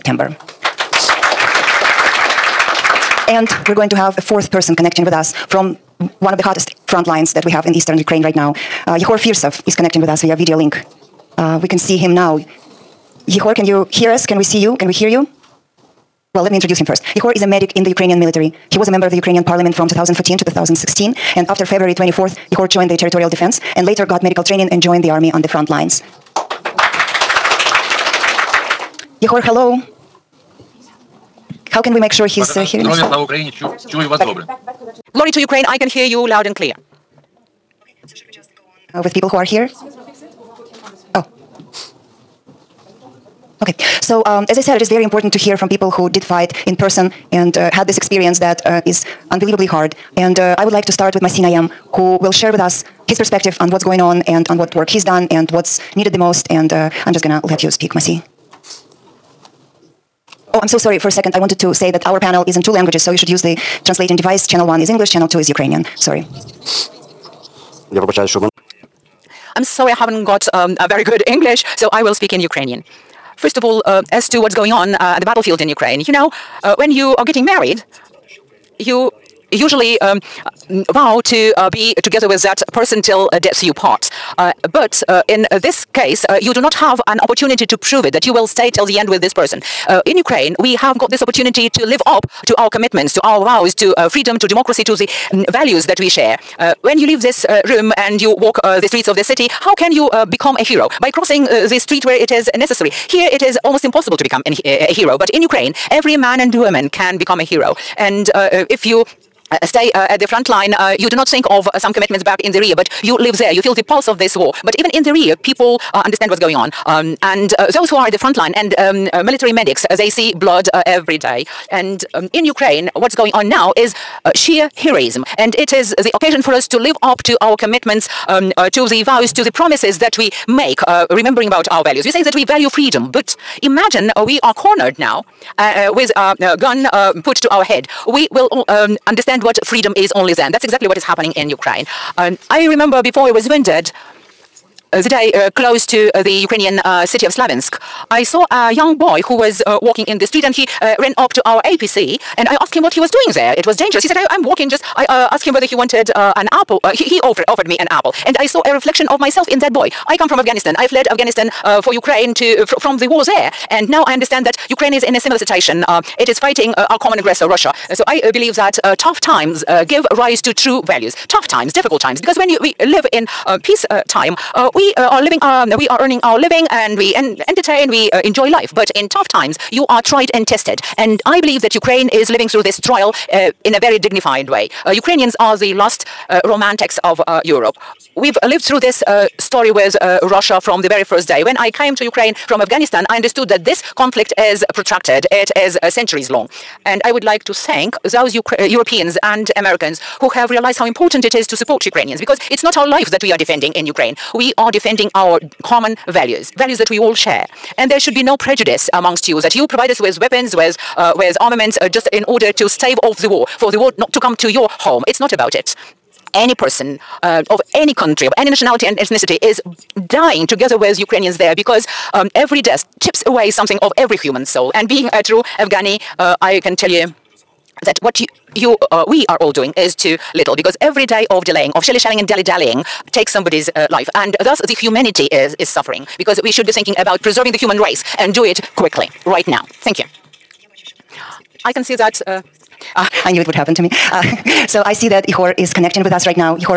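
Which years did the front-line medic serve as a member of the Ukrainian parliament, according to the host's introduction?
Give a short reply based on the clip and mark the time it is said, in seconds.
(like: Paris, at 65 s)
2014 to 2016, at 19 s.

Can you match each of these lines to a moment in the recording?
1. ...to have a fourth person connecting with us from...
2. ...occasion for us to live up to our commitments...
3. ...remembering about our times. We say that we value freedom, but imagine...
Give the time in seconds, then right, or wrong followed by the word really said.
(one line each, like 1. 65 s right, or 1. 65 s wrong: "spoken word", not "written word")
1. 3 s right
2. 126 s right
3. 131 s wrong: "values", not "times".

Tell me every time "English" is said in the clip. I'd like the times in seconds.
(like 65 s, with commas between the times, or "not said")
64 s, 71 s.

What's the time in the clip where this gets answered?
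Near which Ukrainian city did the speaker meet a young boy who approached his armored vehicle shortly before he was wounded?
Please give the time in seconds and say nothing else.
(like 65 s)
147 s.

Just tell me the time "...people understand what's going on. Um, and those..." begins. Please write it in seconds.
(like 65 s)
115 s.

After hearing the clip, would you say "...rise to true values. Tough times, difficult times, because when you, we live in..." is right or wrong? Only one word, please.
right.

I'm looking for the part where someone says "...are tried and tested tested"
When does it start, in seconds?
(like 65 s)
179 s.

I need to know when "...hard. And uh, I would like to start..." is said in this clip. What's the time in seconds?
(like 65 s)
49 s.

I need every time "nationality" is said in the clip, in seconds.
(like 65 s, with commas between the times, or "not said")
218 s.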